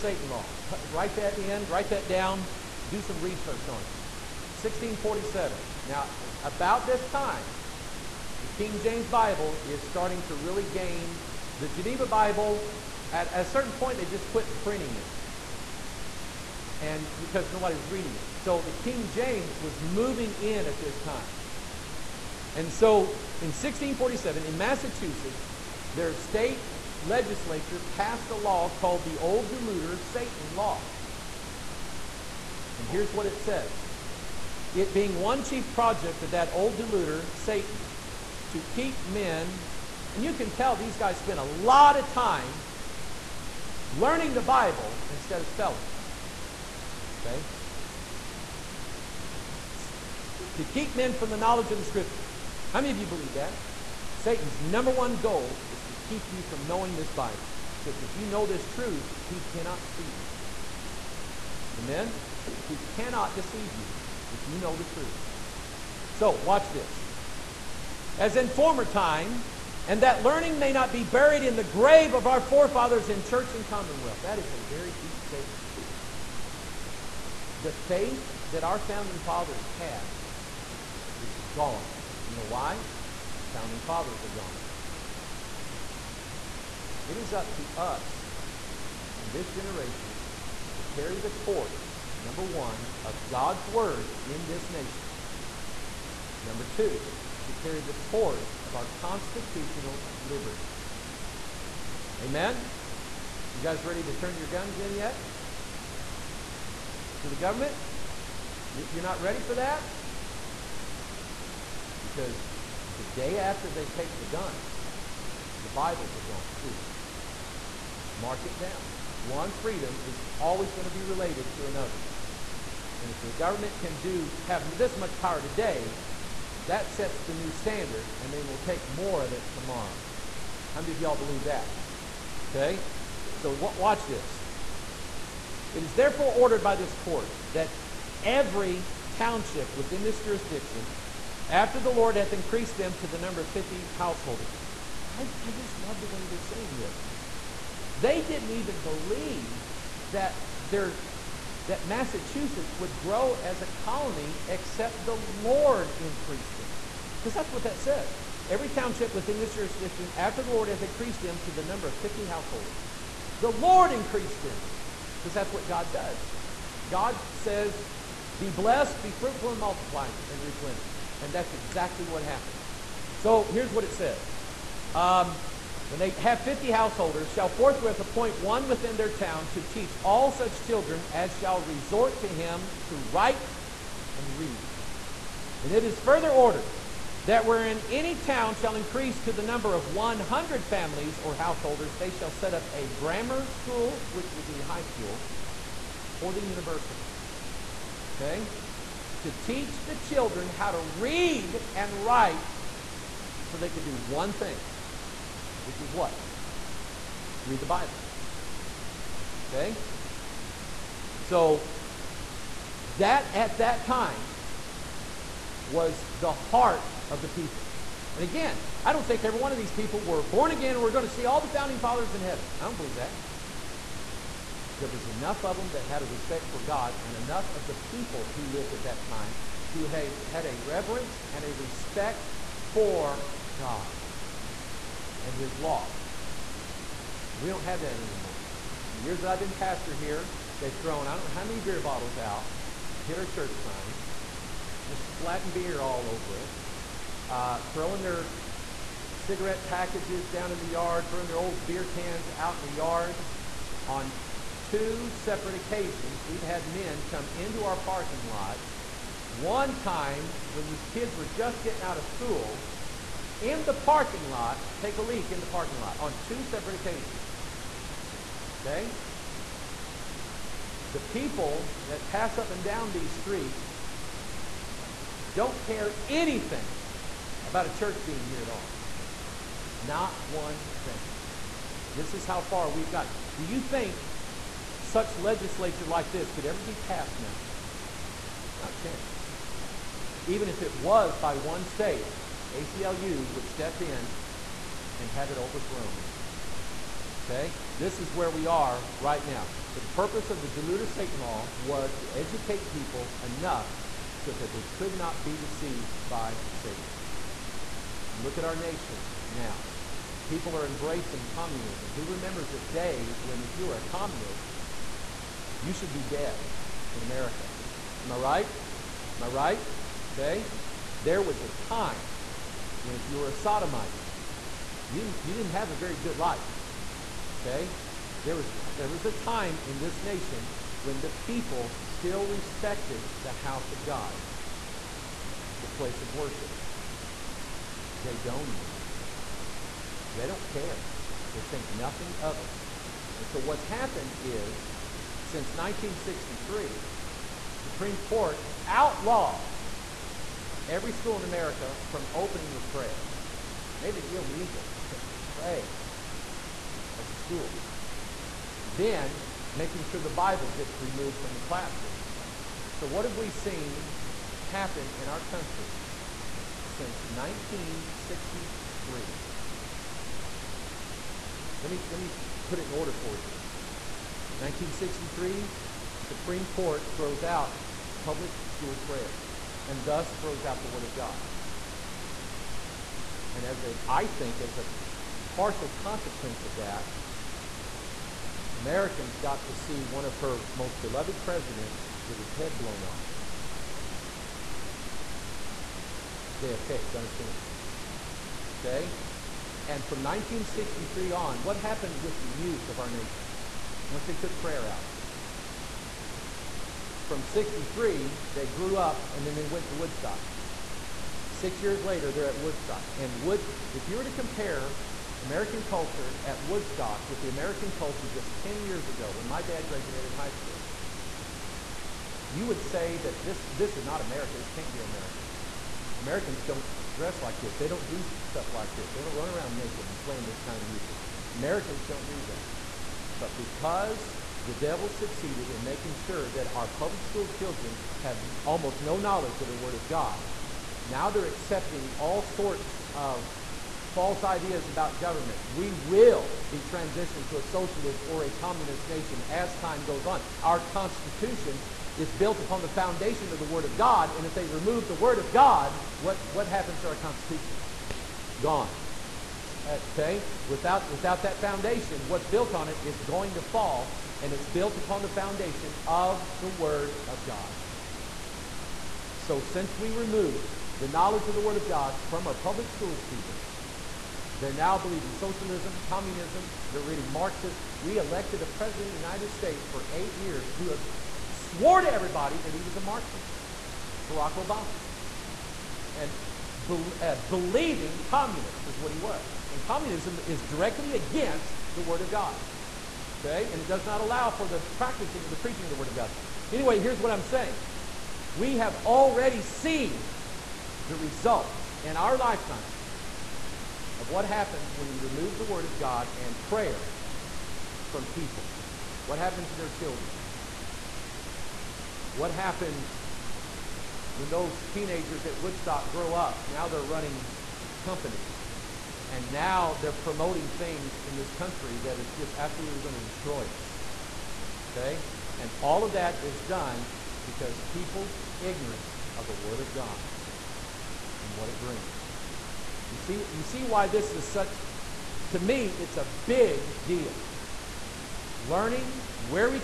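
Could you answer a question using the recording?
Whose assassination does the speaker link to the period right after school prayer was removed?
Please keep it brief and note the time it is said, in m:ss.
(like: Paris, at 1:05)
JFK, at 6:36.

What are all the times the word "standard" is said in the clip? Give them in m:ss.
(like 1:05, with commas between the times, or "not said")
2:07.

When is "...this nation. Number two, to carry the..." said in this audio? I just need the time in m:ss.
1:34.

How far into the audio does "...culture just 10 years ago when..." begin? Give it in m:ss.
6:57.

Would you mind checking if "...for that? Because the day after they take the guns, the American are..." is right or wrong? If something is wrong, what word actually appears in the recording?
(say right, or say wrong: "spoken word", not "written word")
wrong: "Bibles", not "American".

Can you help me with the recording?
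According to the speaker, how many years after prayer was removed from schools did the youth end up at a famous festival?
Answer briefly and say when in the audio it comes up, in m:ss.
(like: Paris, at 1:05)
6, at 6:51.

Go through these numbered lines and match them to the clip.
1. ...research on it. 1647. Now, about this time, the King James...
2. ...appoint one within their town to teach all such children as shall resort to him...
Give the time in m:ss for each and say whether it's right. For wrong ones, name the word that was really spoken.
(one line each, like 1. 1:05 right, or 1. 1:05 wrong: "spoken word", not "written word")
1. 0:03 right
2. 2:57 right.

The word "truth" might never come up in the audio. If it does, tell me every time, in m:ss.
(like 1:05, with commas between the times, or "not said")
0:58, 1:04.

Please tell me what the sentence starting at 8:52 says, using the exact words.
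You see, you see why this is such, to me, it's a big deal.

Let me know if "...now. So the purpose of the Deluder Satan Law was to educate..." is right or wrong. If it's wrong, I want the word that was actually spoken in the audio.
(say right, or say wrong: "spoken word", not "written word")
right.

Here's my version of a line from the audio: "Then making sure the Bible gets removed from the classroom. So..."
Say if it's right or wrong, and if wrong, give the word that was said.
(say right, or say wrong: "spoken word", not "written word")
right.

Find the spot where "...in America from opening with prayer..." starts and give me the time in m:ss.
5:51.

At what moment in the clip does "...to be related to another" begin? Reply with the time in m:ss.
2:00.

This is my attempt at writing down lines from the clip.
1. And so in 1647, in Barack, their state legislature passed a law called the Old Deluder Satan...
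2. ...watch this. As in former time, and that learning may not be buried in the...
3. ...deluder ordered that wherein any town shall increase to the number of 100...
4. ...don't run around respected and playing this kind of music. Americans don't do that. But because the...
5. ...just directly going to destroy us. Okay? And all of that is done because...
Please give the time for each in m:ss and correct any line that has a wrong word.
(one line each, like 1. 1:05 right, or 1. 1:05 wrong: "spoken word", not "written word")
1. 0:22 wrong: "Massachusetts", not "Barack"
2. 1:06 right
3. 3:05 wrong: "further", not "deluder"
4. 7:09 wrong: "naked", not "respected"
5. 8:42 wrong: "absolutely", not "directly".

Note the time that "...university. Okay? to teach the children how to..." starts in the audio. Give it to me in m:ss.
3:16.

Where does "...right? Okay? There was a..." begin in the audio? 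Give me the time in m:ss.
5:19.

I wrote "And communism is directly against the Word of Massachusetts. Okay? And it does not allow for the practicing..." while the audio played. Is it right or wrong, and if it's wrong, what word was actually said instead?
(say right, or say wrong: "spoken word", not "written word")
wrong: "God", not "Massachusetts".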